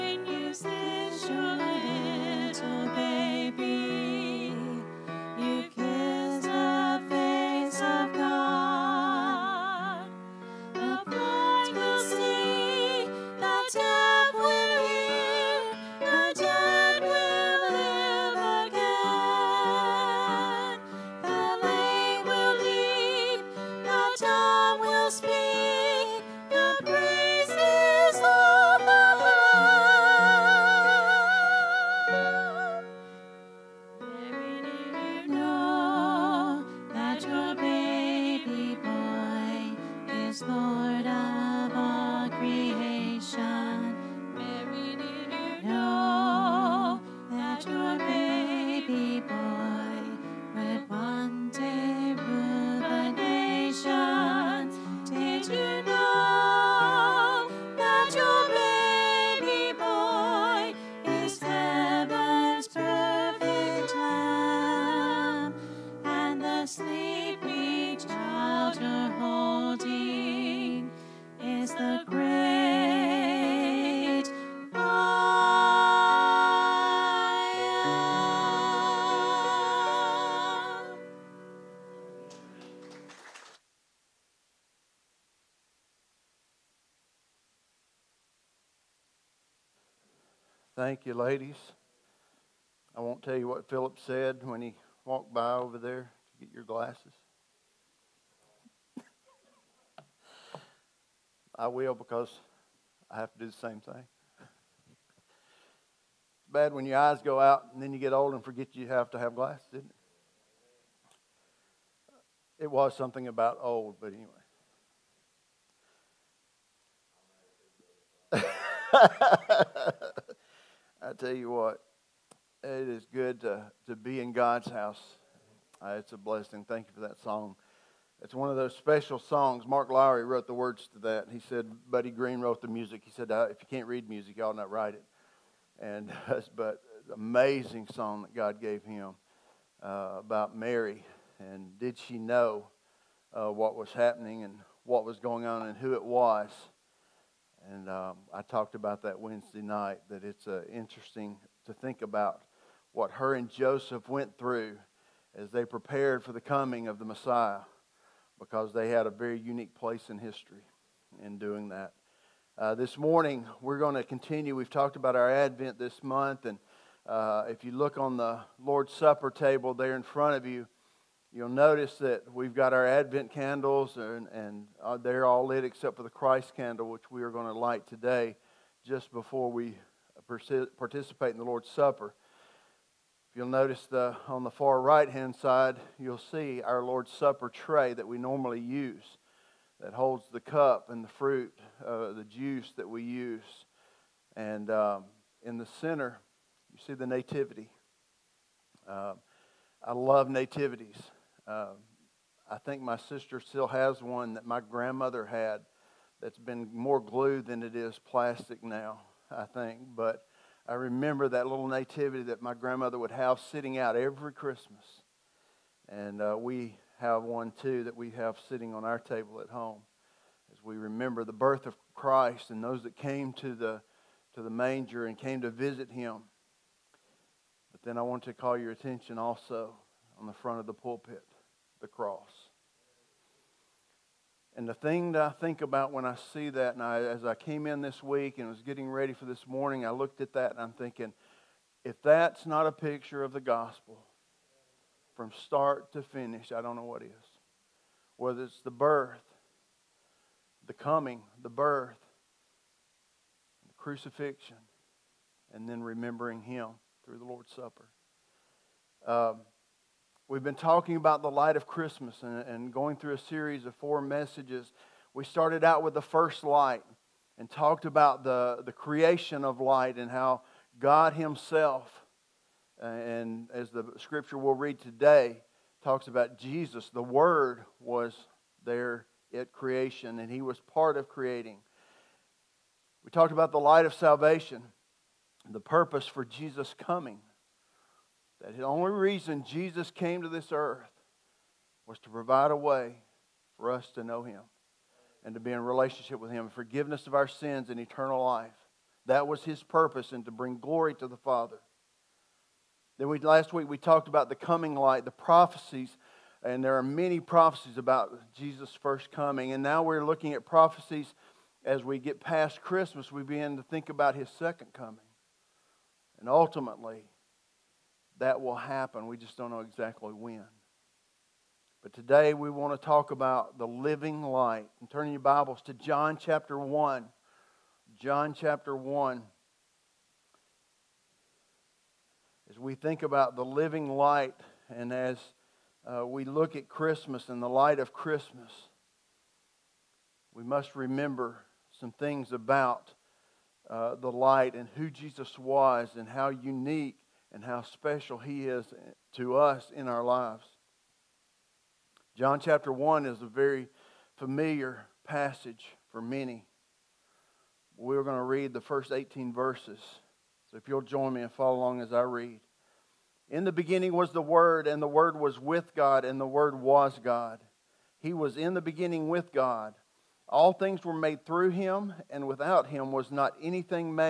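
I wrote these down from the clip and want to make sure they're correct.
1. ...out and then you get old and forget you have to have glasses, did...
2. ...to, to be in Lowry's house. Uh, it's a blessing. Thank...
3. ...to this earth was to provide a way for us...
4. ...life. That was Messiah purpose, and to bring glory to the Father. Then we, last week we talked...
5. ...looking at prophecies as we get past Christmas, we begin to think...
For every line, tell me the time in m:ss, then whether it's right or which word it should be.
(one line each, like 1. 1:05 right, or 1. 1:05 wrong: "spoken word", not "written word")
1. 1:47 right
2. 2:03 wrong: "God", not "Lowry"
3. 4:50 right
4. 4:58 wrong: "His", not "Messiah"
5. 5:10 right.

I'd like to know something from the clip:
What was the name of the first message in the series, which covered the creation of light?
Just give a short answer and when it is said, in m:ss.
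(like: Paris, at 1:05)
The first light, at 4:25.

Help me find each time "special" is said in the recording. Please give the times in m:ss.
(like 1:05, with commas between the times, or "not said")
2:08, 5:47.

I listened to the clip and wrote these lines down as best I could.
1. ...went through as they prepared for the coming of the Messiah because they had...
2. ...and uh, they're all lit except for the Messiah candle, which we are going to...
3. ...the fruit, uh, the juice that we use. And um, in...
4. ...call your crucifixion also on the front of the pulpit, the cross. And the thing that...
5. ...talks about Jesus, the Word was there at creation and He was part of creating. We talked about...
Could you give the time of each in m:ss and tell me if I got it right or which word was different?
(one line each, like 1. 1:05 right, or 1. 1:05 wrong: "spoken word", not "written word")
1. 2:34 right
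2. 2:54 wrong: "Christ", not "Messiah"
3. 3:11 right
4. 3:48 wrong: "attention", not "crucifixion"
5. 4:35 right.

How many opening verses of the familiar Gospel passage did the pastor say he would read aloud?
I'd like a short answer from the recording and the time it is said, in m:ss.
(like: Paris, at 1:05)
18, at 5:58.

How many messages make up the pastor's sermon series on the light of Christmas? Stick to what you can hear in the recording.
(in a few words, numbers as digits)
4.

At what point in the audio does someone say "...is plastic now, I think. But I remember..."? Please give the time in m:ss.
3:27.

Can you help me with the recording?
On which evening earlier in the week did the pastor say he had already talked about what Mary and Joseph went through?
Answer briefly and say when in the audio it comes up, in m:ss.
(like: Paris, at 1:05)
Wednesday night, at 2:29.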